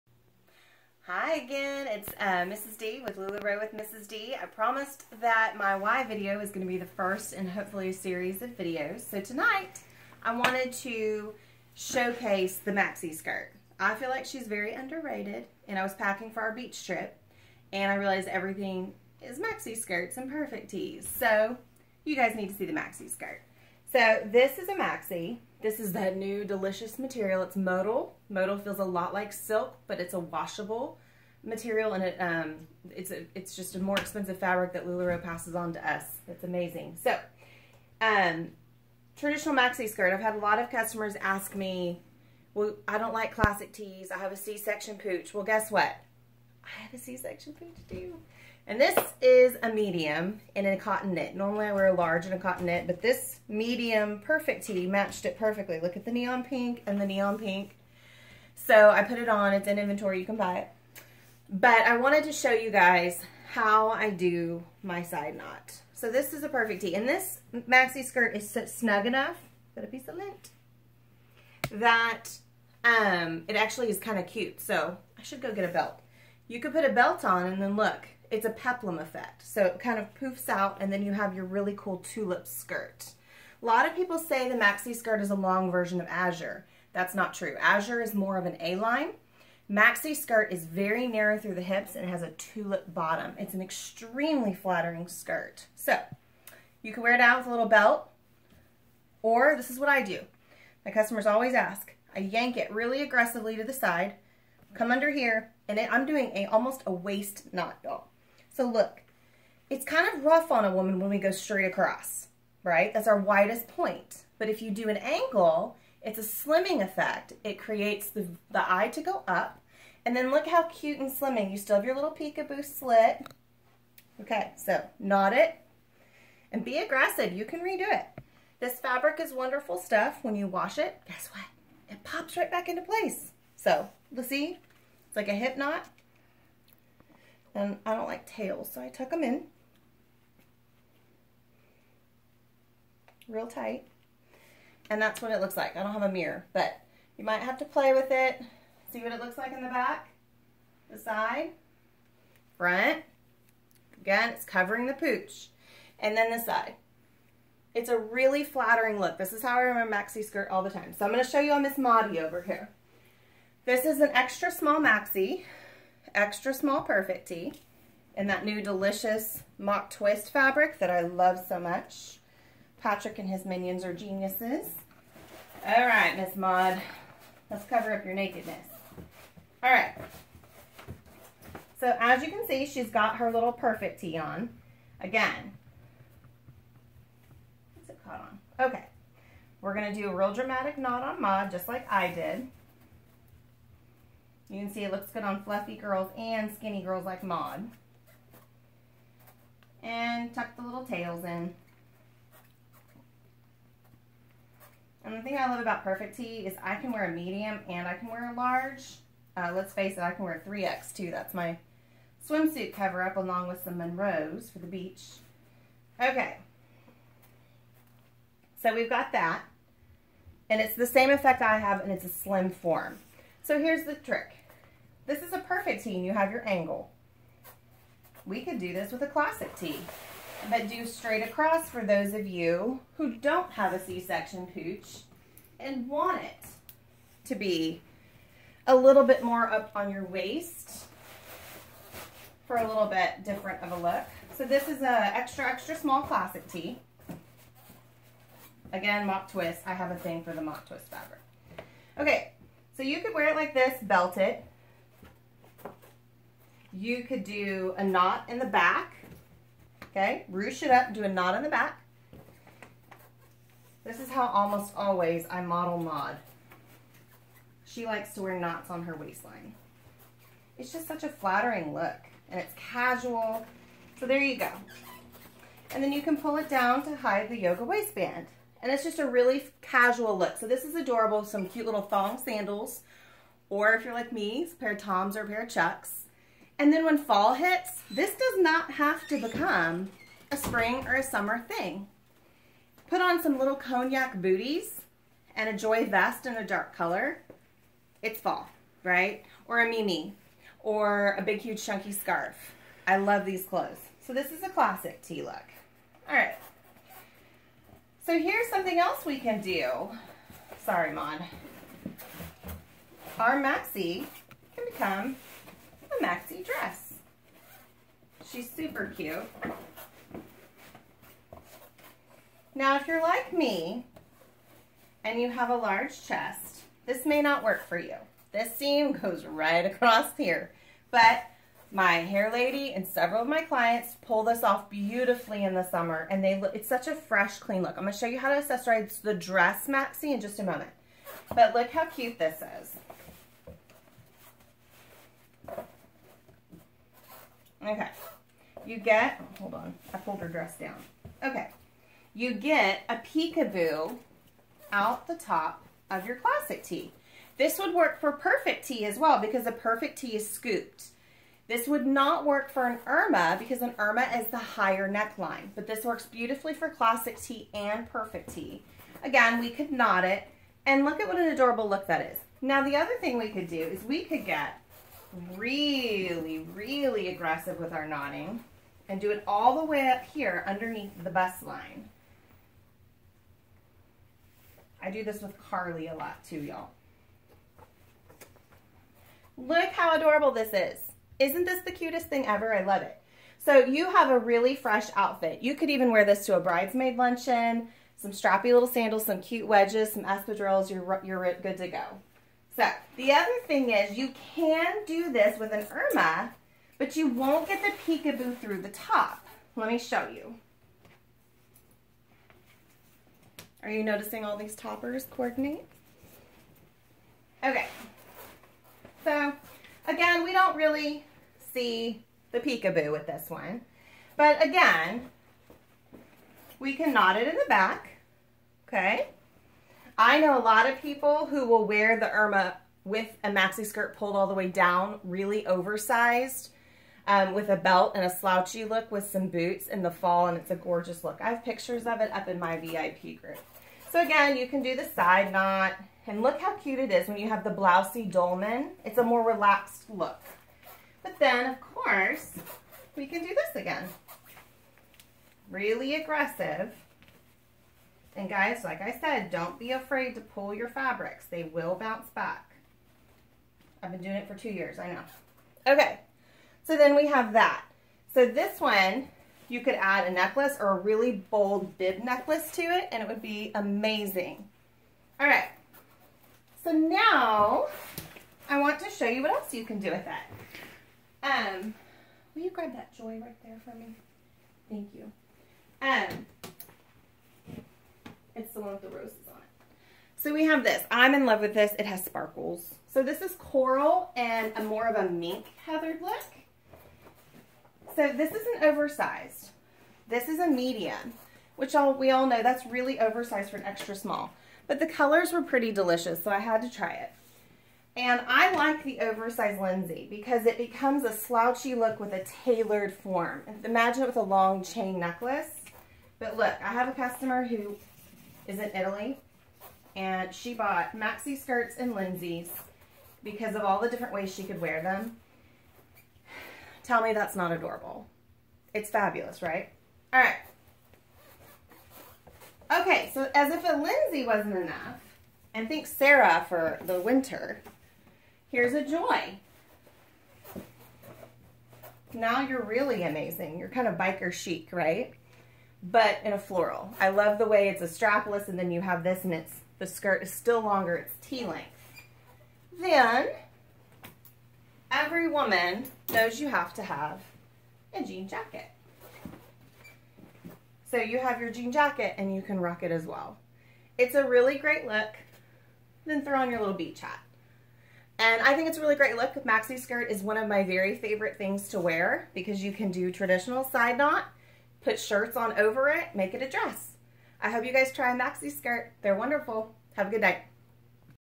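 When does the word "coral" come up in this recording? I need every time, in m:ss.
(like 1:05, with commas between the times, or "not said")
8:13.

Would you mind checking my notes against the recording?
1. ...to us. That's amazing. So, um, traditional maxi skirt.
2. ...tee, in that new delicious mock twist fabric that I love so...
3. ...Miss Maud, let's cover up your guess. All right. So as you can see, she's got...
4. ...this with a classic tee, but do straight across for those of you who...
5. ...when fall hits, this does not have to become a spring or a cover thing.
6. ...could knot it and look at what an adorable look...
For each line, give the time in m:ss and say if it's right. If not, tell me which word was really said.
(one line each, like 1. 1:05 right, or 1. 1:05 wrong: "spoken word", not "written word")
1. 0:35 right
2. 2:47 right
3. 2:56 wrong: "nakedness", not "guess"
4. 3:48 right
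5. 4:46 wrong: "summer", not "cover"
6. 6:09 right.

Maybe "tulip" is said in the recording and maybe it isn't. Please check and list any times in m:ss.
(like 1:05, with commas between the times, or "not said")
1:21, 1:32.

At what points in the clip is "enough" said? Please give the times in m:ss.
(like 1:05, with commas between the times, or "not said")
1:09, 8:54.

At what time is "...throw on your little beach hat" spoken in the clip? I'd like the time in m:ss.
9:26.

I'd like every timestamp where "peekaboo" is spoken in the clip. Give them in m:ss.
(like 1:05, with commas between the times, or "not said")
2:02, 5:52, 6:47, 7:02.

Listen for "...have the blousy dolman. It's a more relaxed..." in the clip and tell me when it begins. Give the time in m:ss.
7:27.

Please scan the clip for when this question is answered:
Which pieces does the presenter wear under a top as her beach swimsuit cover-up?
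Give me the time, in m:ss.
3:33.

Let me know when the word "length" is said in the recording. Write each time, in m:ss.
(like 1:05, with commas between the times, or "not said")
9:11.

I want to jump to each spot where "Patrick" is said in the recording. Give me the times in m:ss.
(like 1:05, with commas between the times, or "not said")
2:52.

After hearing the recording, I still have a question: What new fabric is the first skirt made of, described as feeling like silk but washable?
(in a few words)
Modal.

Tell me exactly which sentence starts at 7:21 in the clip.
I have pictures of it up in my VIP group.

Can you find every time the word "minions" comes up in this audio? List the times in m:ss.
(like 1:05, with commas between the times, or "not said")
2:53.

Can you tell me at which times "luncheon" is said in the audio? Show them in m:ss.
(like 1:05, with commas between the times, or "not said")
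6:36.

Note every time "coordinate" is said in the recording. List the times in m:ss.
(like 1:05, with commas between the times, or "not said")
6:55.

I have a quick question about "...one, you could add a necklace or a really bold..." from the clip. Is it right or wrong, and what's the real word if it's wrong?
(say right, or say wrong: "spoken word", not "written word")
right.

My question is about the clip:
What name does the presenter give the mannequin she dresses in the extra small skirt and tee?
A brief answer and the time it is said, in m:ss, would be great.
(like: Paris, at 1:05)
Miss Maudie, at 2:41.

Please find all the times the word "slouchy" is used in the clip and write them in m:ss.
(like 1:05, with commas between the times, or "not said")
7:18, 8:31.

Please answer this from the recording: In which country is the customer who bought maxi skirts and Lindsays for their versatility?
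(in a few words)
Italy.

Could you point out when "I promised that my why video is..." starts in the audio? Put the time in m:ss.
0:04.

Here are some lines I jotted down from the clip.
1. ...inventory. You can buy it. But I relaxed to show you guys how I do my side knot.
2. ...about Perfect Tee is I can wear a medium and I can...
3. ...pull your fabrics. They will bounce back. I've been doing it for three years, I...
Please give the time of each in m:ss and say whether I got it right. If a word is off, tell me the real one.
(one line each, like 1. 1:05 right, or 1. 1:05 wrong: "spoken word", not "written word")
1. 0:59 wrong: "wanted", not "relaxed"
2. 3:25 right
3. 7:40 wrong: "two", not "three".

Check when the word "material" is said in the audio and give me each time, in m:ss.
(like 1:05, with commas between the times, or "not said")
0:26, 0:31.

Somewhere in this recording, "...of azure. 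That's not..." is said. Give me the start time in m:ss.
1:25.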